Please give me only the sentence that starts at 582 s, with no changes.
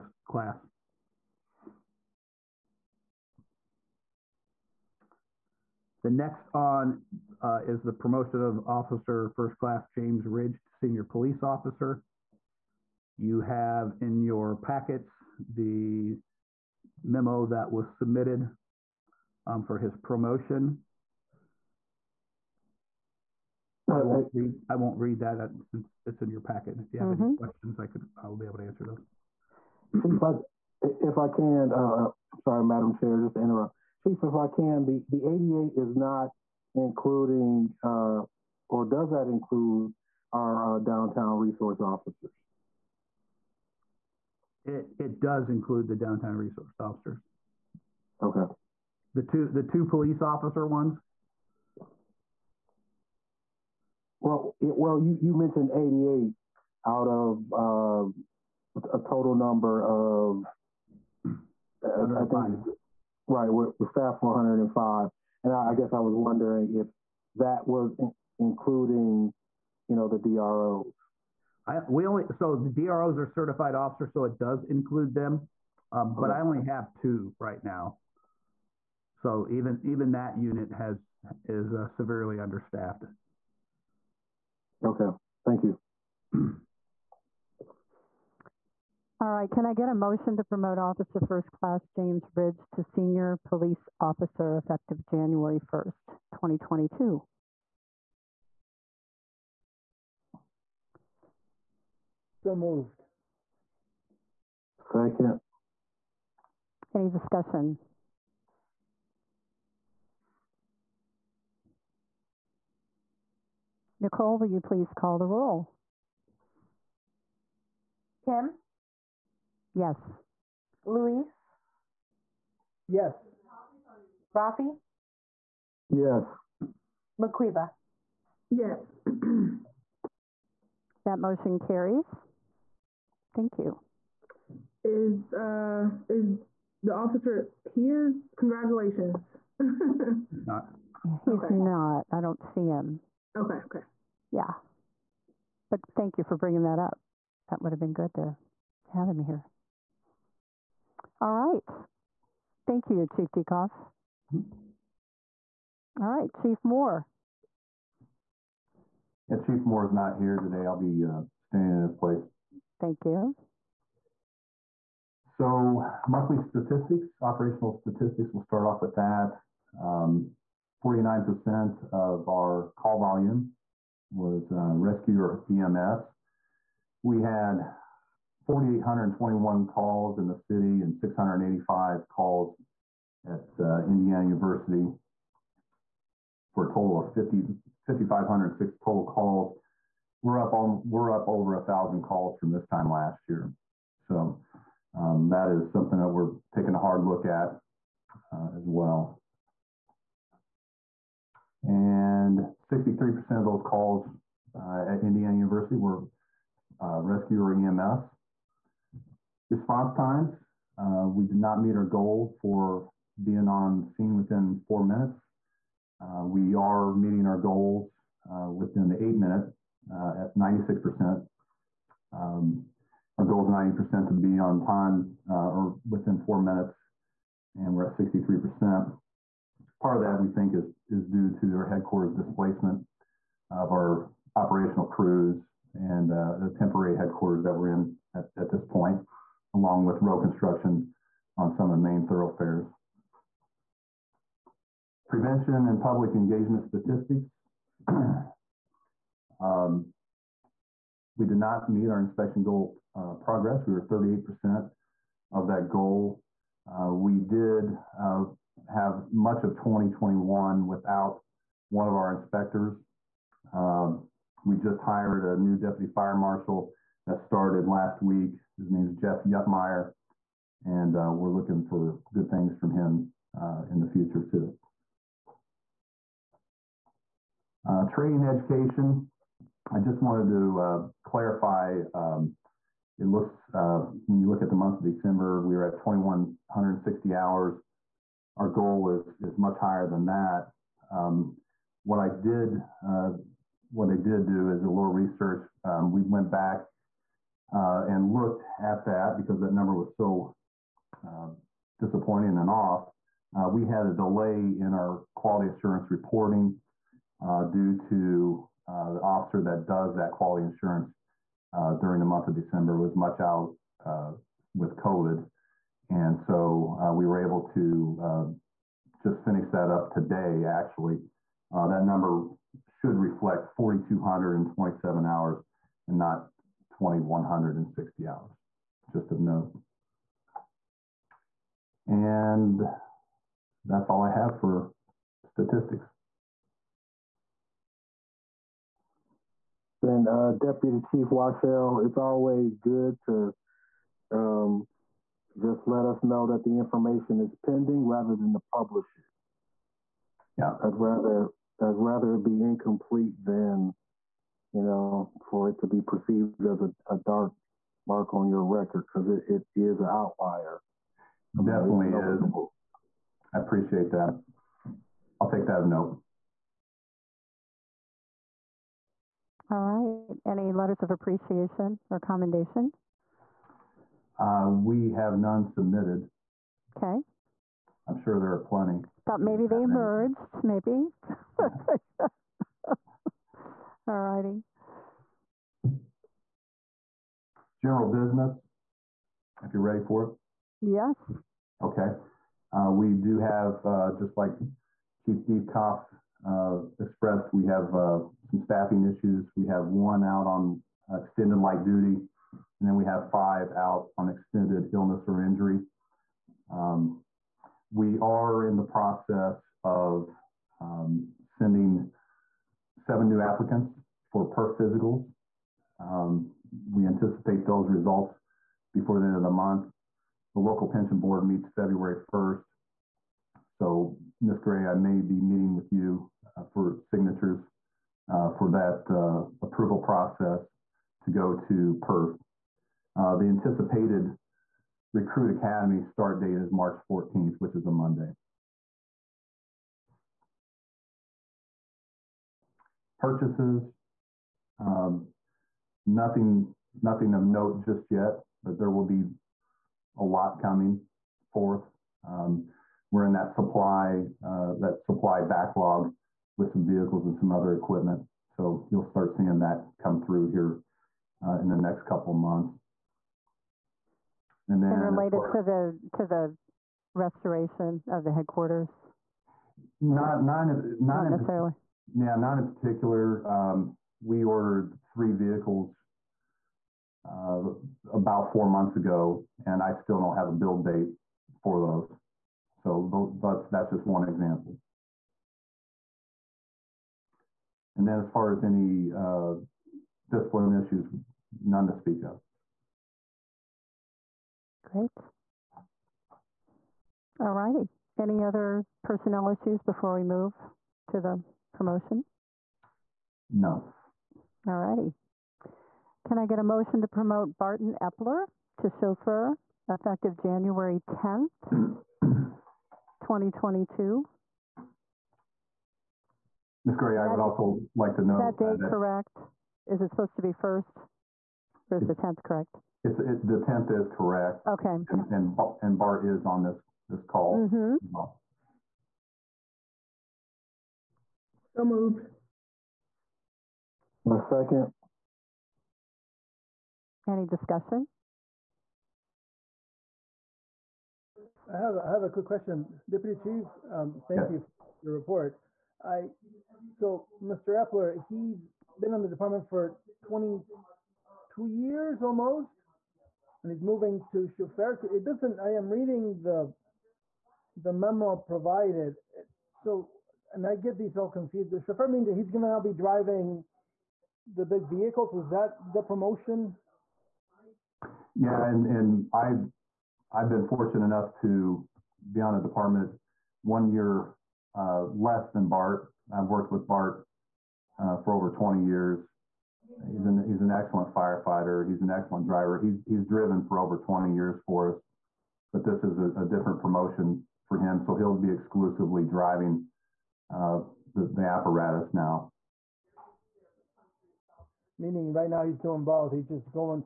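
He's he's driven for over 20 years for us, but this is a, a different promotion for him.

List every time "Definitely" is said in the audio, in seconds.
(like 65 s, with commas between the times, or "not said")
361 s.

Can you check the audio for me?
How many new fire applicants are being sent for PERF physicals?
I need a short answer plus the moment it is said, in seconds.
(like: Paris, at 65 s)
seven, at 412 s.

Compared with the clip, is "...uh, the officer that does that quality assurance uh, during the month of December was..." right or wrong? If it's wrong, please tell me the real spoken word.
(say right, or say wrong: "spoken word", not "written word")
right.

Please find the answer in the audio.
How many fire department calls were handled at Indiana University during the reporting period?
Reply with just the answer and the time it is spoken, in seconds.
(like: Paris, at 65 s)
685, at 180 s.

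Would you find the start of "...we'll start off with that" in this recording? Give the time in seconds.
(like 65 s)
168 s.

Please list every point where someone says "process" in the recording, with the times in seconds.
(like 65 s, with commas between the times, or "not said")
408 s, 429 s.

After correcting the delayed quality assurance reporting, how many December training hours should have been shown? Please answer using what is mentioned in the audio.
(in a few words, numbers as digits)
4,227.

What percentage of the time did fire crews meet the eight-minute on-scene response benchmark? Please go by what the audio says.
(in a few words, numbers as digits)
96%.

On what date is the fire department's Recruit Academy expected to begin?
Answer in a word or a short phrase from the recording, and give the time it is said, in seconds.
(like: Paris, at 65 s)
March 14th, at 436 s.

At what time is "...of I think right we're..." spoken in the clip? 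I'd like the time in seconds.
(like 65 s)
59 s.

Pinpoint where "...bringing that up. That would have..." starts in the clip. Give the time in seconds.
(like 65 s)
146 s.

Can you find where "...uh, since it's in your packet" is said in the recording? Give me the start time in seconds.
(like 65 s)
25 s.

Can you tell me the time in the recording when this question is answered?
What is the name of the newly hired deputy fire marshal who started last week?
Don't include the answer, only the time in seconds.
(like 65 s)
268 s.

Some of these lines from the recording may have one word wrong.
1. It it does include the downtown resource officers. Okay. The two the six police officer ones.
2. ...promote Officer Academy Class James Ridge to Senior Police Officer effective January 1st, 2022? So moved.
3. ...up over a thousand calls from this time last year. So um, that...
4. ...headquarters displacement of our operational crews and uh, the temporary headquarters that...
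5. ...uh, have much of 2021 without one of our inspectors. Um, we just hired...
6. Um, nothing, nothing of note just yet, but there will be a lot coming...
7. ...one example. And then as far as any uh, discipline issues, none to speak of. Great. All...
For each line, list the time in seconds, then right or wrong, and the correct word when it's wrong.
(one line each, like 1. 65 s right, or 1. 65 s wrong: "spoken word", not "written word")
1. 44 s wrong: "two", not "six"
2. 90 s wrong: "First", not "Academy"
3. 191 s right
4. 231 s right
5. 257 s right
6. 444 s right
7. 483 s right.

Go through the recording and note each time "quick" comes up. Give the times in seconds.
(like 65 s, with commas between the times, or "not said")
542 s.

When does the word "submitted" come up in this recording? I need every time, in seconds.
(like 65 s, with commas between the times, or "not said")
17 s, 375 s.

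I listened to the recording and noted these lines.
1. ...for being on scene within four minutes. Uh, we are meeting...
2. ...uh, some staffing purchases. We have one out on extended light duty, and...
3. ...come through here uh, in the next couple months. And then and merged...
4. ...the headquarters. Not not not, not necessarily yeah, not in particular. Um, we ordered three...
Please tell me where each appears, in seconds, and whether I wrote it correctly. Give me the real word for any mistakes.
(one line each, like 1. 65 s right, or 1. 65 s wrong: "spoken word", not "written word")
1. 212 s right
2. 397 s wrong: "issues", not "purchases"
3. 459 s wrong: "related", not "merged"
4. 468 s right.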